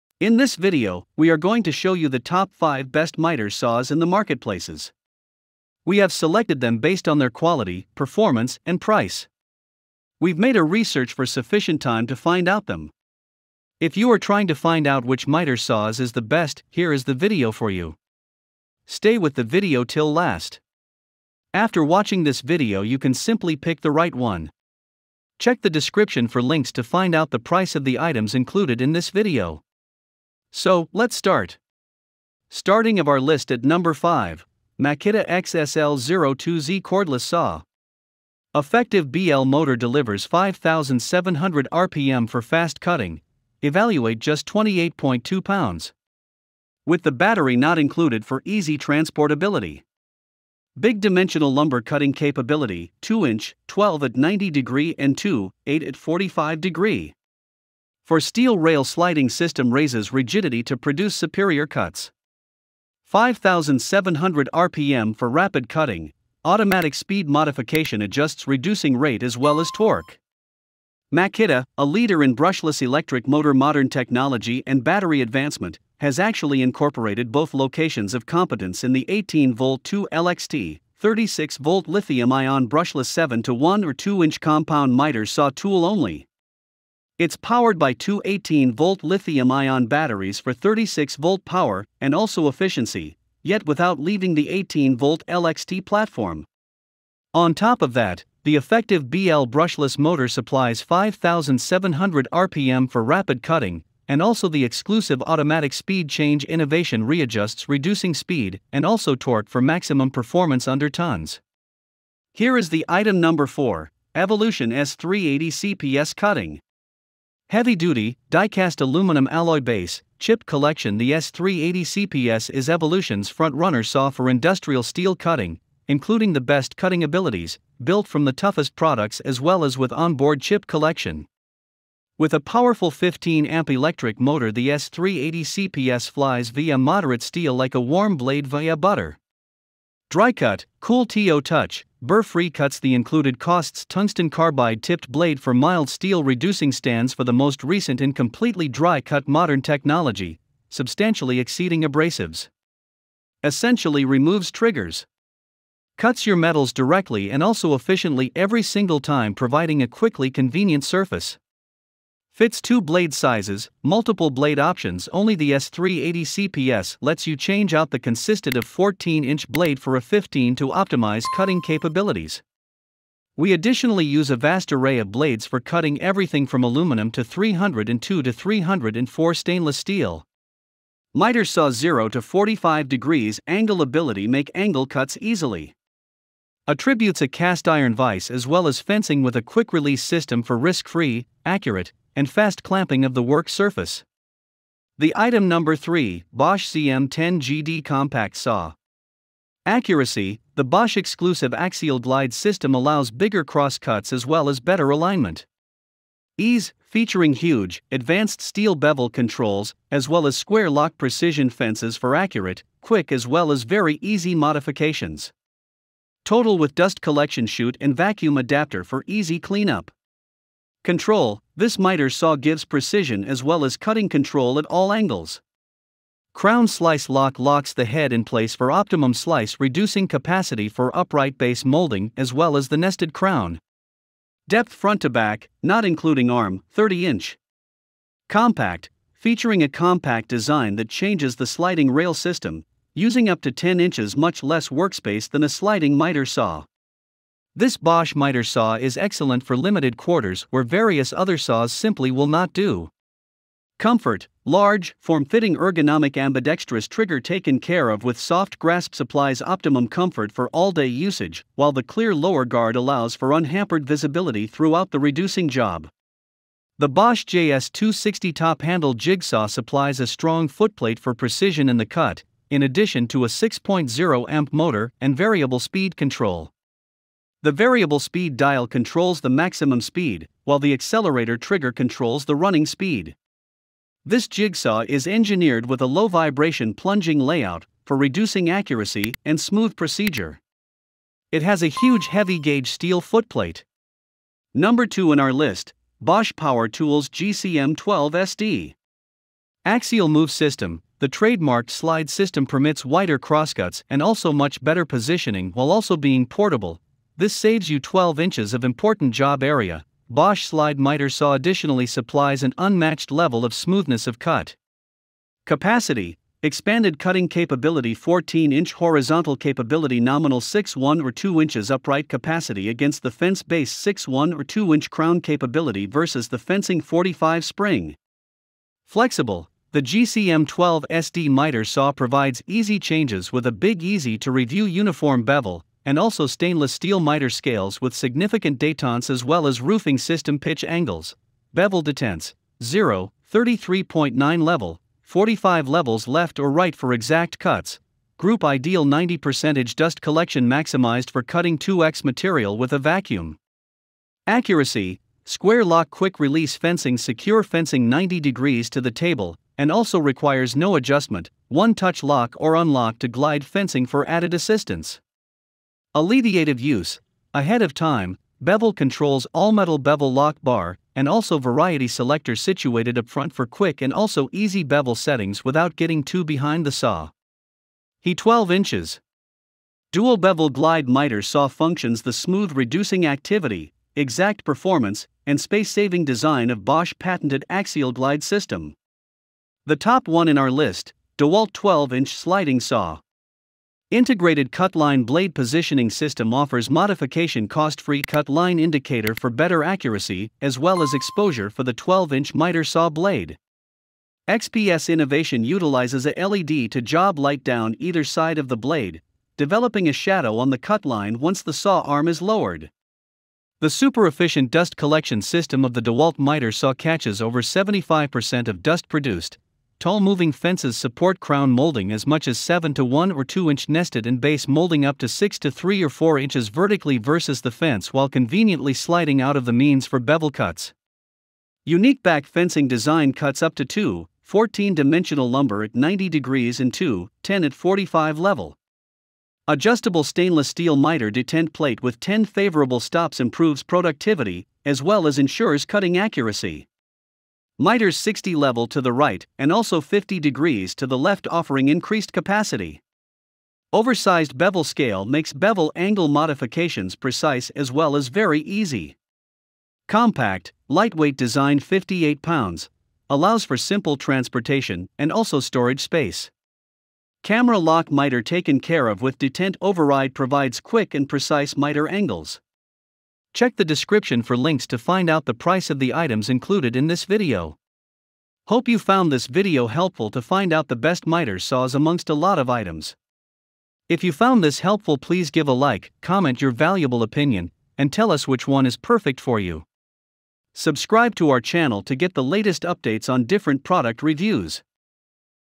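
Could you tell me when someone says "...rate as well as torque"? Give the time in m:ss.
1:08.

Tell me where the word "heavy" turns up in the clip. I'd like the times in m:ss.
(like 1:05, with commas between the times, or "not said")
1:57, 4:52.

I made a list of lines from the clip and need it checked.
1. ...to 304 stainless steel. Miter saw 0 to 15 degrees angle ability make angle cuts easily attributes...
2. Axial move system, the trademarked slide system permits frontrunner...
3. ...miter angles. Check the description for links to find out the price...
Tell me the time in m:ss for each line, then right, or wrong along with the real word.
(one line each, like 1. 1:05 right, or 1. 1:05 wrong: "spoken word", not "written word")
1. 2:58 wrong: "45", not "15"
2. 4:59 wrong: "wider", not "frontrunner"
3. 7:51 right.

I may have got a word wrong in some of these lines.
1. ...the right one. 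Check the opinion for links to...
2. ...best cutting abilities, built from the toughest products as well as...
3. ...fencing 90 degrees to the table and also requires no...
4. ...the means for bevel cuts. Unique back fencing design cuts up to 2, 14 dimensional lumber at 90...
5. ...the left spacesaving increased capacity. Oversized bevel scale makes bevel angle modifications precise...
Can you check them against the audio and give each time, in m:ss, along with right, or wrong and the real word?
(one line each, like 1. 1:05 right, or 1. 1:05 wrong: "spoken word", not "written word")
1. 0:23 wrong: "description", not "opinion"
2. 2:06 right
3. 5:57 right
4. 7:09 right
5. 7:30 wrong: "offering", not "spacesaving".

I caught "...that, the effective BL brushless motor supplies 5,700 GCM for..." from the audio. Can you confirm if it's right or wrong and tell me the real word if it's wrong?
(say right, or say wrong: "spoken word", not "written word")
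wrong: "RPM", not "GCM".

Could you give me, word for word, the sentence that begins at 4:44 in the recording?
This jigsaw is engineered with a low vibration plunging layout for reducing accuracy and smooth procedure.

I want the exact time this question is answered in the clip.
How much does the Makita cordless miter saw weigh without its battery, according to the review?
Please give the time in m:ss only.
0:44.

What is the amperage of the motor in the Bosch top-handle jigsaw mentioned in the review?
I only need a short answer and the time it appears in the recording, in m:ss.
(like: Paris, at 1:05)
6.0 amp, at 4:33.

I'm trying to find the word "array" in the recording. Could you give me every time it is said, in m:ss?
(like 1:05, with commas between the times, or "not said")
2:54.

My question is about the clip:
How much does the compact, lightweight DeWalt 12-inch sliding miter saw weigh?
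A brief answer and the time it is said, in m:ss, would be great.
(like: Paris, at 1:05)
58 pounds, at 7:41.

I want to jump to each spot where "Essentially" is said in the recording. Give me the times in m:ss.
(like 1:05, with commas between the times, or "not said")
2:33.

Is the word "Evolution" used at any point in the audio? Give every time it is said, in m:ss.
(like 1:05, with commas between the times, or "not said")
1:54, 2:02.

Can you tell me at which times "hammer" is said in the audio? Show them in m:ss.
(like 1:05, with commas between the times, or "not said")
not said.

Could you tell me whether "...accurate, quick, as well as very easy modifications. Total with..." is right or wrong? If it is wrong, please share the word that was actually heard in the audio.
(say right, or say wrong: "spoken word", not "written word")
right.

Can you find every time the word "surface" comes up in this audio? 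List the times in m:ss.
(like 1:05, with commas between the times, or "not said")
2:40, 3:13.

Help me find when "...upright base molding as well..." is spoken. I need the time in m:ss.
3:50.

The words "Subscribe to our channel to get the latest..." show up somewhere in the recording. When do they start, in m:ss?
8:10.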